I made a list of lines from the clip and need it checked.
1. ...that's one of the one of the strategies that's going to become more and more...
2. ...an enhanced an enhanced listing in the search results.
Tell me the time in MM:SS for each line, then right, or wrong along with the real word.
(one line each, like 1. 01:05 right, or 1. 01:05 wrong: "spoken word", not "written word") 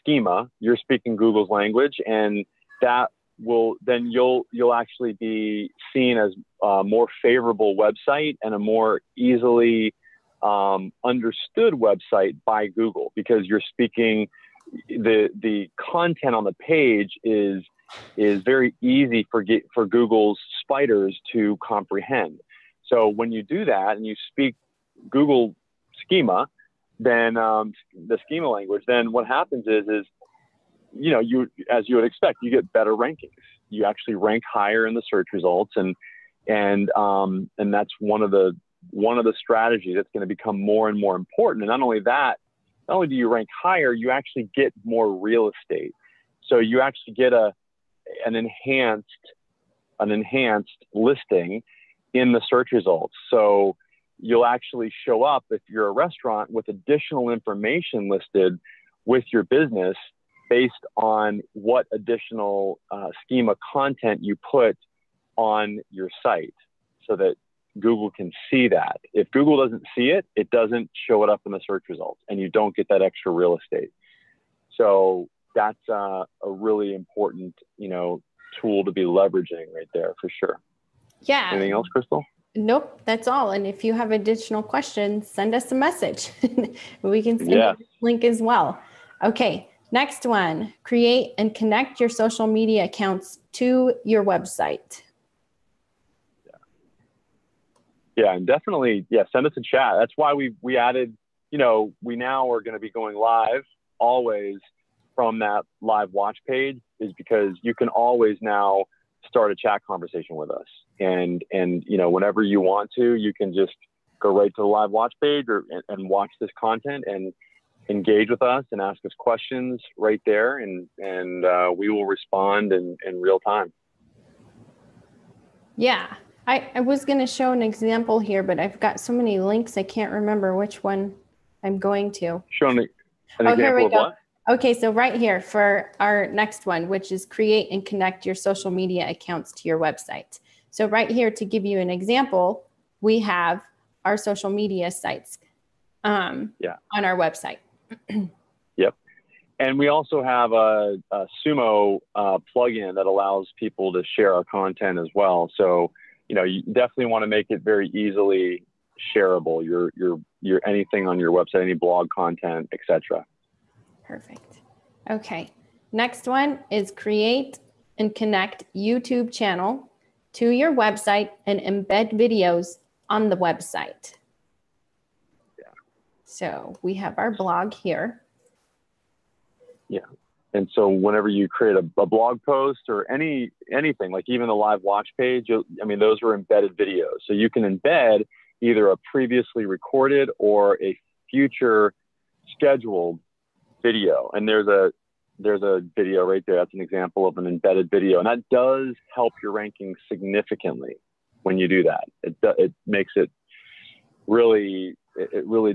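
1. 00:37 right
2. 00:48 right.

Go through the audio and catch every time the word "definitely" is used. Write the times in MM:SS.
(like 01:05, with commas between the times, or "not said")
01:38, 02:36.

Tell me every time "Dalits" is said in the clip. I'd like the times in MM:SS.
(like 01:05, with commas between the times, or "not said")
not said.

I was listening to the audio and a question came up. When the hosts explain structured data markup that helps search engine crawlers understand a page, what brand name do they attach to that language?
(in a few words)
Google schema.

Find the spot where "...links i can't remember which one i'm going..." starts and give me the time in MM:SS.
02:09.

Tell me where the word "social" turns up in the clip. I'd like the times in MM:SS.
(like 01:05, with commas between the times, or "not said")
01:32, 02:18, 02:24.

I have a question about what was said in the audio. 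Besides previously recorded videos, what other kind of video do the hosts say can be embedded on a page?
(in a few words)
future scheduled video.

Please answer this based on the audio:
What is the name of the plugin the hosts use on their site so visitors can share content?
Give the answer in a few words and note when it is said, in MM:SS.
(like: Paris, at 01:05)
Sumo, at 02:31.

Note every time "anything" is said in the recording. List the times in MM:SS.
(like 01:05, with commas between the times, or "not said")
01:21, 02:40, 03:03.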